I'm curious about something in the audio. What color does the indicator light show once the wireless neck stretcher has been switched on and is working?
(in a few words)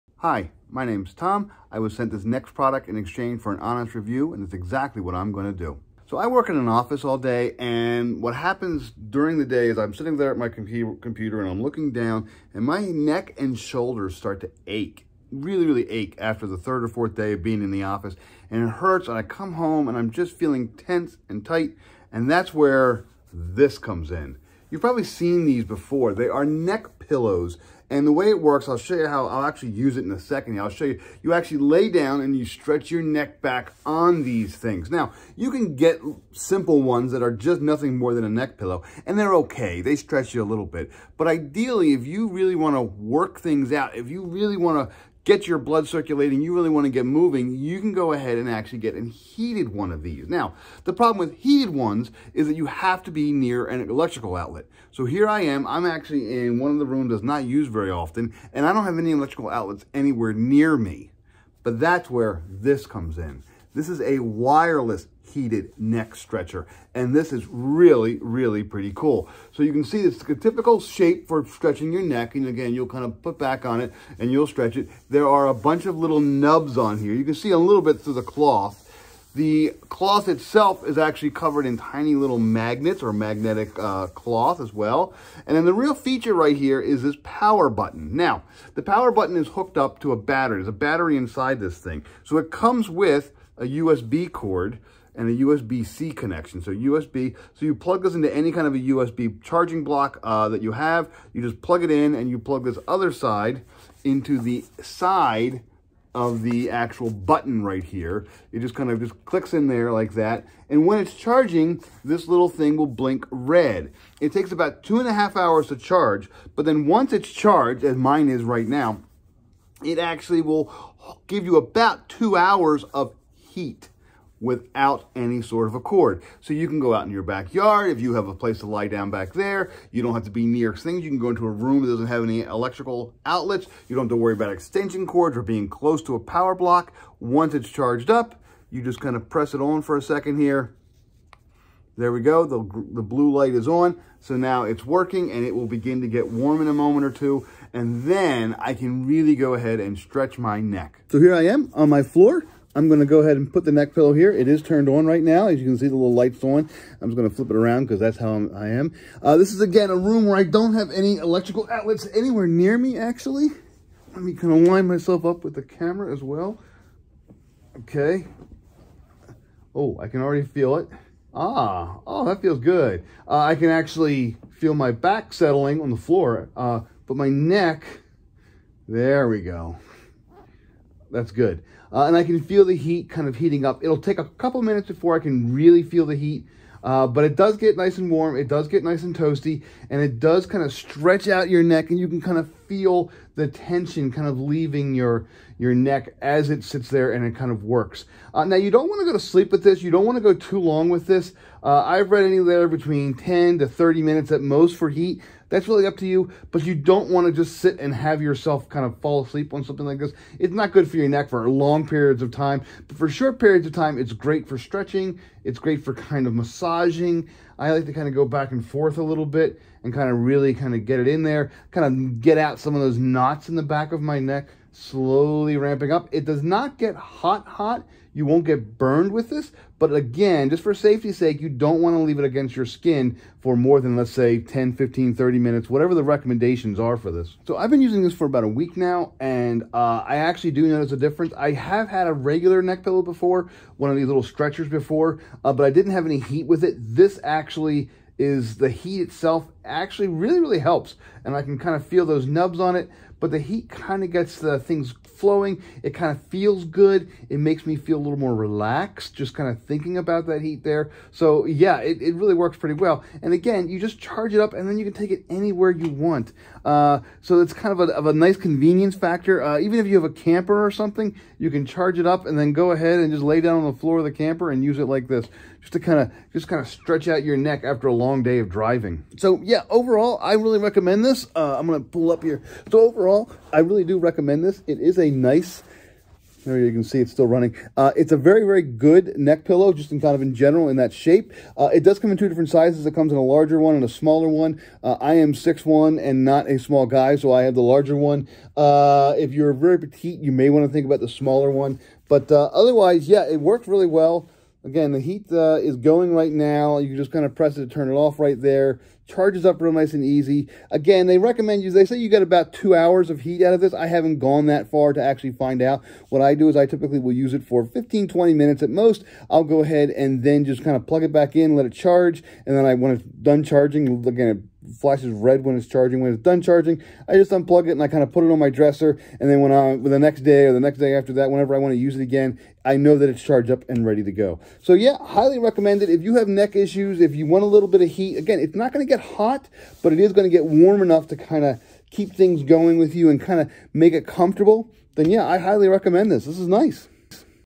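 Blue.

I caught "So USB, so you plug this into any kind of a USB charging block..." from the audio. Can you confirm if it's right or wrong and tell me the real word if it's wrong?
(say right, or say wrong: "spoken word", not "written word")
right.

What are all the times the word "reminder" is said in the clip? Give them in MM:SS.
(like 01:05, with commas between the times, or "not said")
not said.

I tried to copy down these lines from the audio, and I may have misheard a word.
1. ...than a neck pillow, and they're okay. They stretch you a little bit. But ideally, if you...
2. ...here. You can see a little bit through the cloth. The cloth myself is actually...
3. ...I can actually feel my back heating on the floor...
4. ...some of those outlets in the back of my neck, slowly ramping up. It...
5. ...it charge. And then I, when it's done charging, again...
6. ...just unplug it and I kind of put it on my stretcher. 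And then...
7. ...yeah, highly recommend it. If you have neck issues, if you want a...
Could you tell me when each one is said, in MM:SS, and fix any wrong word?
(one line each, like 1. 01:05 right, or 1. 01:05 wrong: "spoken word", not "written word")
1. 00:38 right
2. 01:16 wrong: "itself", not "myself"
3. 02:53 wrong: "settling", not "heating"
4. 03:42 wrong: "knots", not "outlets"
5. 05:21 right
6. 05:27 wrong: "dresser", not "stretcher"
7. 05:34 right.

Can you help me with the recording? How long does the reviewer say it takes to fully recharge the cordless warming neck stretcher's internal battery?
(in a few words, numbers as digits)
2.5 hours.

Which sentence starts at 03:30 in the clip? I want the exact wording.
It's not good for your neck for long periods of time, but for short periods of time, it's great for stretching.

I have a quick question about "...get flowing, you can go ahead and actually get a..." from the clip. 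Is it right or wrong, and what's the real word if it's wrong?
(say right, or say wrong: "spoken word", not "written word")
wrong: "moving", not "flowing".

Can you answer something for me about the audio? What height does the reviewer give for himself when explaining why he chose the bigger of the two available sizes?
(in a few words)
6'1".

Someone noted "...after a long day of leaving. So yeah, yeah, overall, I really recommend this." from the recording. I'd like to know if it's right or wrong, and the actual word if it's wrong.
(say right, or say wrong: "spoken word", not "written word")
wrong: "driving", not "leaving".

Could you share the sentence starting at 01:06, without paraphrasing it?
And this is really, really pretty cool.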